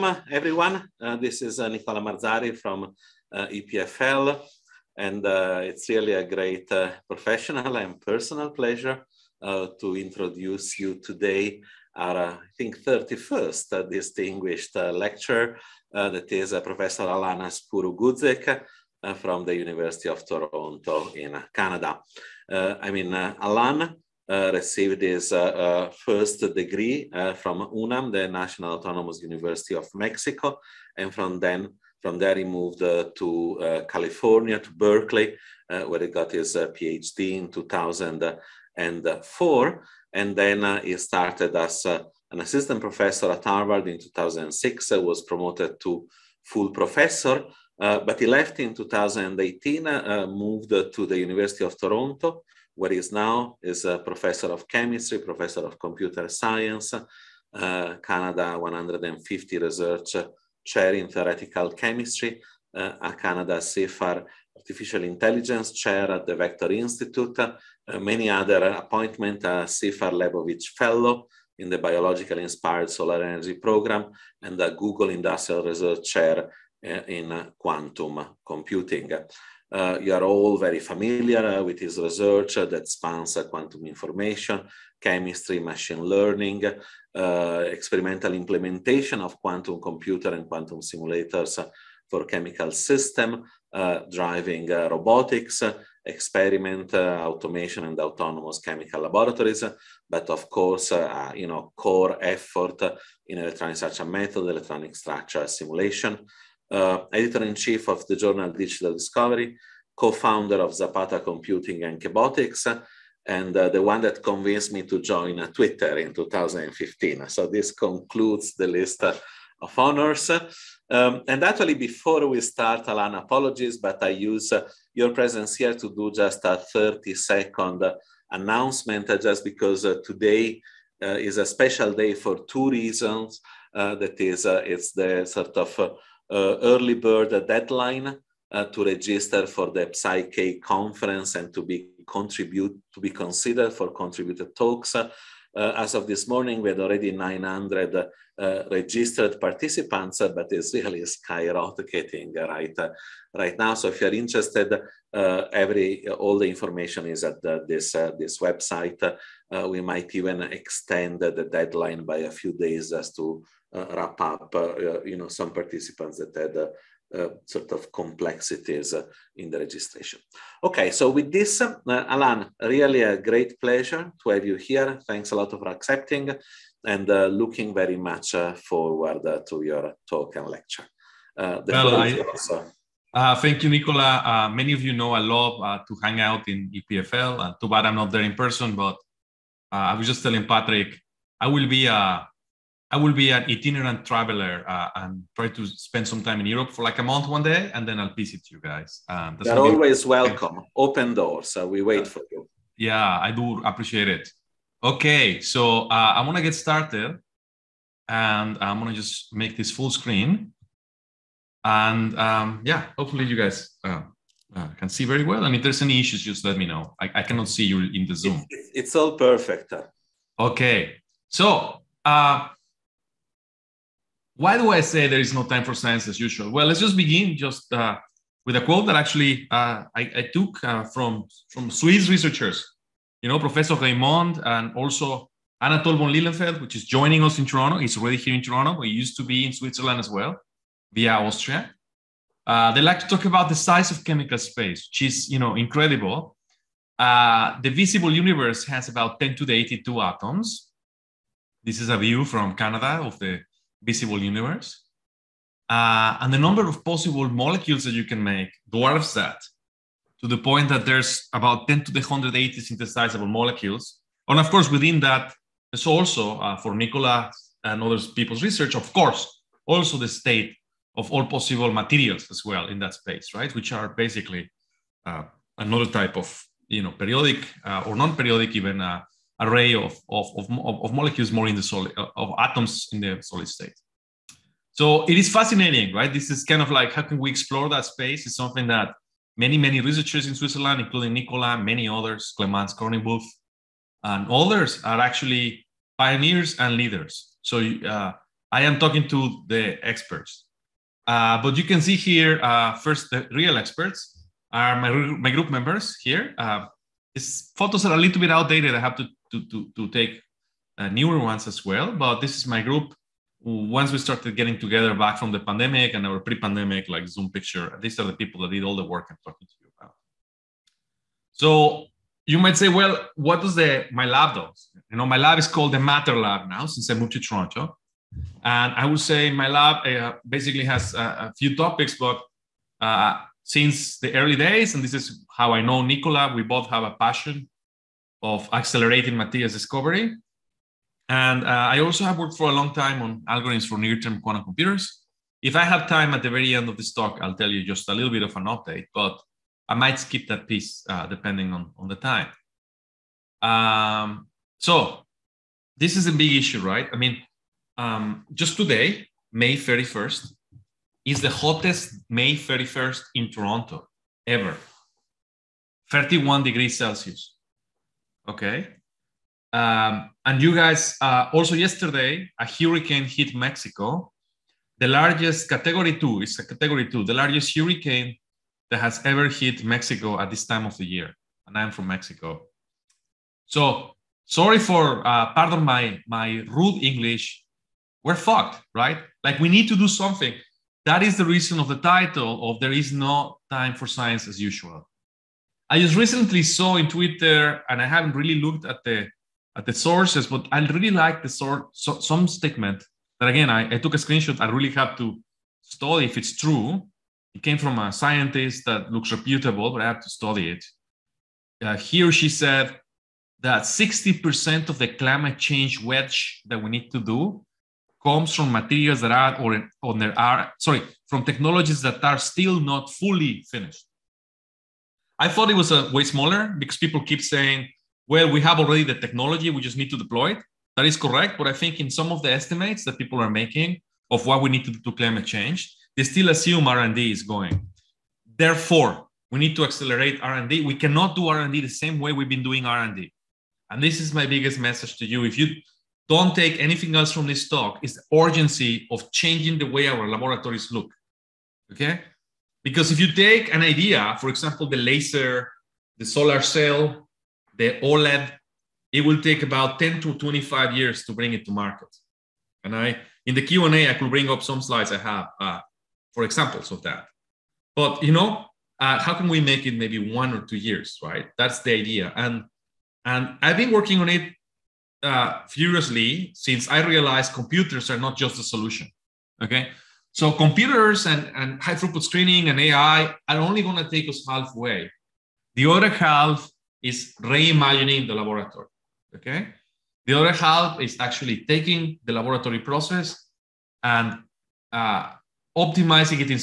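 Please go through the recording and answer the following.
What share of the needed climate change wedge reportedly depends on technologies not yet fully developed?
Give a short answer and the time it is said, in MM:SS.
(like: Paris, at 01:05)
60%, at 06:53.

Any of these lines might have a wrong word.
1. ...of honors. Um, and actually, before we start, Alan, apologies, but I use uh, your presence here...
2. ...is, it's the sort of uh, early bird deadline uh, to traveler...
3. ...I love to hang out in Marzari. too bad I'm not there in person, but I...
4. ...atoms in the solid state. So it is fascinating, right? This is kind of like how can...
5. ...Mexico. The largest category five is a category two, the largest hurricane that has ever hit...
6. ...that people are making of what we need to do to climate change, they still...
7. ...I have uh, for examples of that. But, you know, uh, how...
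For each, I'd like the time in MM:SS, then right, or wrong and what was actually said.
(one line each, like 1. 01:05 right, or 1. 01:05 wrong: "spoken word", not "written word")
1. 01:59 right
2. 02:14 wrong: "register", not "traveler"
3. 03:05 wrong: "EPFL", not "Marzari"
4. 04:42 right
5. 06:13 wrong: "two", not "five"
6. 07:12 right
7. 07:44 right.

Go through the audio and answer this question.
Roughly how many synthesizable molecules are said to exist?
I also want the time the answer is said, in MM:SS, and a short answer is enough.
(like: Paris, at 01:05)
10 to the 180, at 04:21.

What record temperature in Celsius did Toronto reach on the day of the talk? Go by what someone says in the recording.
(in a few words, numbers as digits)
31 degrees.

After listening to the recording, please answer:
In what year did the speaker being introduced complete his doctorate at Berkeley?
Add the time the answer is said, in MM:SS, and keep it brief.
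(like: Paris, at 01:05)
2004, at 00:37.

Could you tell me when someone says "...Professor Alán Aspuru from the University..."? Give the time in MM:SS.
00:16.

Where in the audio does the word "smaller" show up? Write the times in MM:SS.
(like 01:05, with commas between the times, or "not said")
07:06.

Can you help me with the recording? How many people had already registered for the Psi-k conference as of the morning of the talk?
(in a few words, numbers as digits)
900.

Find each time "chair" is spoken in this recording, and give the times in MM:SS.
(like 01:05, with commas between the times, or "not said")
01:00, 01:05, 01:16.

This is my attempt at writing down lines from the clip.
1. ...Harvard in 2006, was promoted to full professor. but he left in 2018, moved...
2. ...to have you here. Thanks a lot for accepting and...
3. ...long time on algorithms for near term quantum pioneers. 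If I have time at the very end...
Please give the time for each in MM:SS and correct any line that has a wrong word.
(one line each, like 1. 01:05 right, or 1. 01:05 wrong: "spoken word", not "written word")
1. 00:43 right
2. 02:54 right
3. 05:42 wrong: "computers", not "pioneers".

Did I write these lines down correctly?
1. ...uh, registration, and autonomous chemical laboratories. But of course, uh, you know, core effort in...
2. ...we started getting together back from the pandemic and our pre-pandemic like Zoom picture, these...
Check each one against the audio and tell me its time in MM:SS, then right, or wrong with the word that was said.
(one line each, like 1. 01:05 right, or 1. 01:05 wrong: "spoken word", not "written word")
1. 01:36 wrong: "automation", not "registration"
2. 05:13 right.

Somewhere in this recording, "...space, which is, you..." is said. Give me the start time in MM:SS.
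04:04.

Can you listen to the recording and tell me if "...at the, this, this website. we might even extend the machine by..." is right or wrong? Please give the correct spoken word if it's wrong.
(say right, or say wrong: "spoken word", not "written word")
wrong: "deadline", not "machine".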